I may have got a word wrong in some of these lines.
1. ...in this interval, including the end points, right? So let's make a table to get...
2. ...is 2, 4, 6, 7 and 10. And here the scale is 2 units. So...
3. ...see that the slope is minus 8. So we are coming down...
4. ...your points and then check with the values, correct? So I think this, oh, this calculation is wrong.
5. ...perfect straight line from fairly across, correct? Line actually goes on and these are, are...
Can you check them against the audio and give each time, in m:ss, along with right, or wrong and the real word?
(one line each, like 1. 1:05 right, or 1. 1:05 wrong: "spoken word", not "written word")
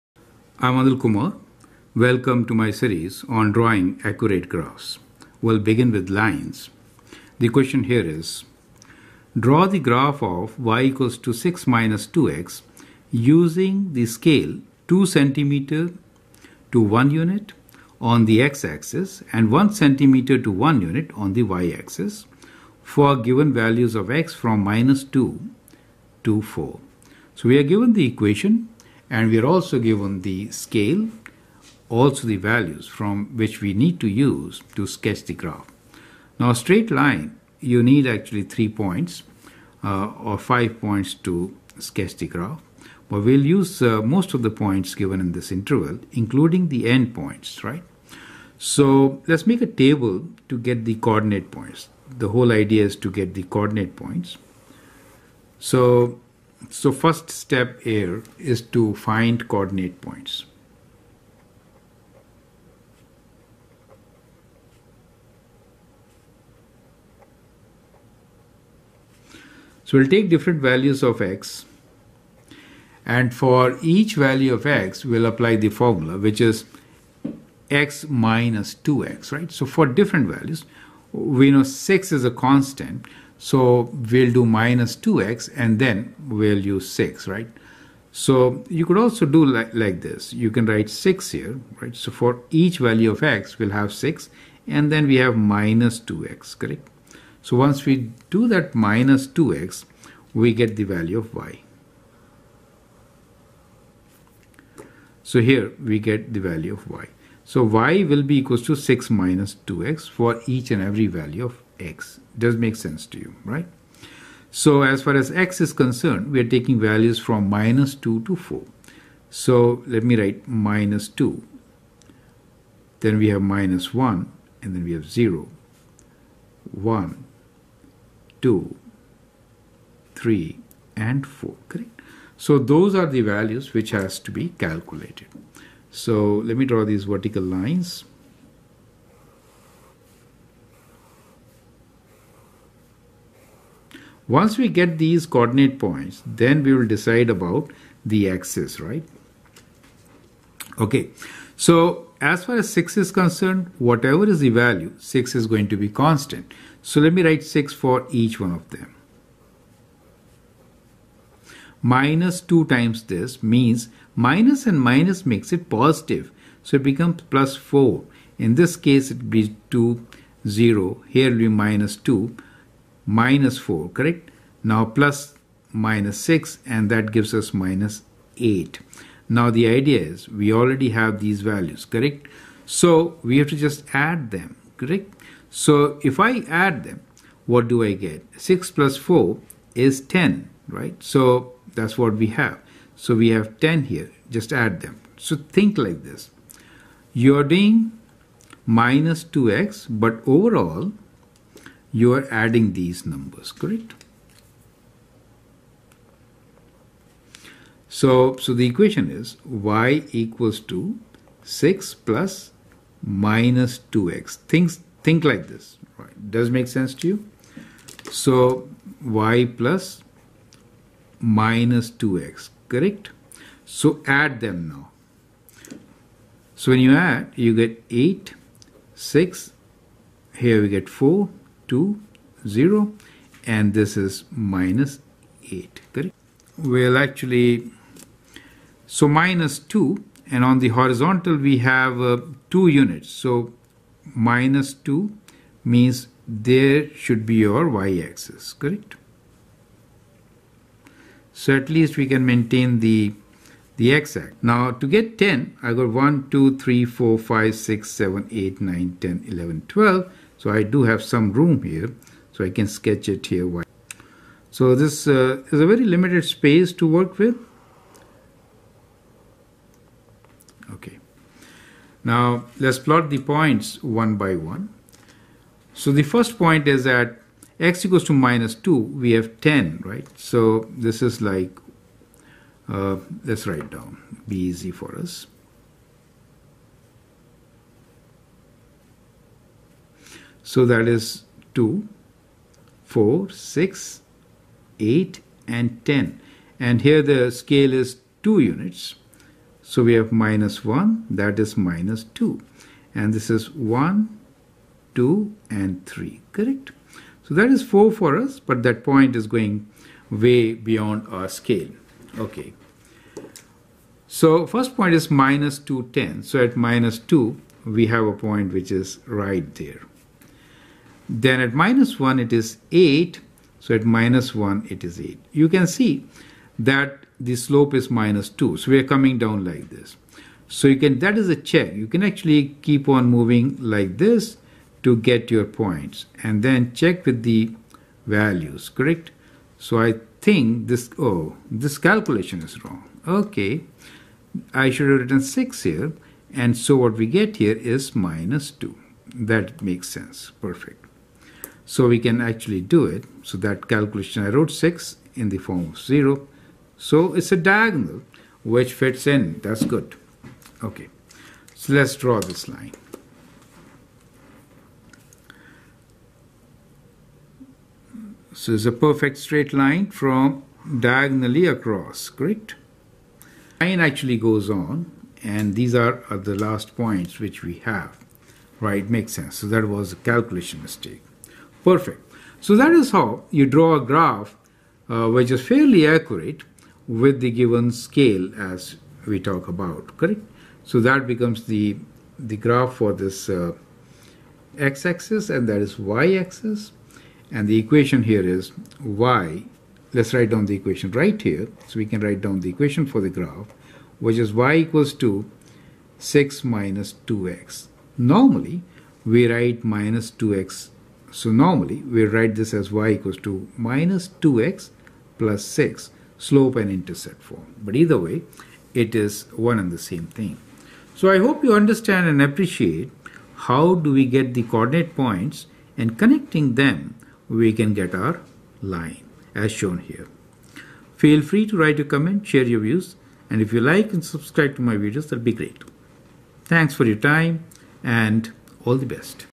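1. 0:45 right
2. 4:50 wrong: "8", not "7"
3. 5:25 wrong: "2", not "8"
4. 5:35 right
5. 6:08 wrong: "diagonally", not "fairly".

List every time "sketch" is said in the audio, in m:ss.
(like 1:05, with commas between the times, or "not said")
0:34, 0:41, 4:22.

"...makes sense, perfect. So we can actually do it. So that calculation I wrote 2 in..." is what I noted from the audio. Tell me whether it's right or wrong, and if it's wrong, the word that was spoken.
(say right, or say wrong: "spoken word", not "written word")
wrong: "6", not "2".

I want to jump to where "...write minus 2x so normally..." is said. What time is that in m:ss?
6:49.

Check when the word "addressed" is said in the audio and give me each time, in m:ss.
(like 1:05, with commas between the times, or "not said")
not said.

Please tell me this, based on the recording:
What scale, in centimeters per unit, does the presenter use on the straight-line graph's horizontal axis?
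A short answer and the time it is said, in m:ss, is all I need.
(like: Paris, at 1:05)
2 centimeter to 1 unit, at 0:14.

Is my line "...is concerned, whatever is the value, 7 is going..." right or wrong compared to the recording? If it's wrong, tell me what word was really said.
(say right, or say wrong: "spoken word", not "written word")
wrong: "6", not "7".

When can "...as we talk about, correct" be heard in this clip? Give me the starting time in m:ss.
6:28.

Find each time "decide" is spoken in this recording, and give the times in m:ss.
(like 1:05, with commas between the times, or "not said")
2:26.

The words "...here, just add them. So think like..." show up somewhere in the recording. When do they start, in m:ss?
3:13.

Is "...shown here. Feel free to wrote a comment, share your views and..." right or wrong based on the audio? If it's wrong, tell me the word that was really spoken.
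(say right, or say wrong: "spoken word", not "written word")
wrong: "write", not "wrote".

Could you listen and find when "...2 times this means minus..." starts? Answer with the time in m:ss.
2:42.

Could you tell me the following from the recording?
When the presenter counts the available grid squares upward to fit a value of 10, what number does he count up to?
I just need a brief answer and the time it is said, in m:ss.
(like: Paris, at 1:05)
12, at 4:19.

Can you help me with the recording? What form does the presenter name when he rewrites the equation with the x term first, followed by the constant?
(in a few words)
slope and intercept form.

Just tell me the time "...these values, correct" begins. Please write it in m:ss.
3:01.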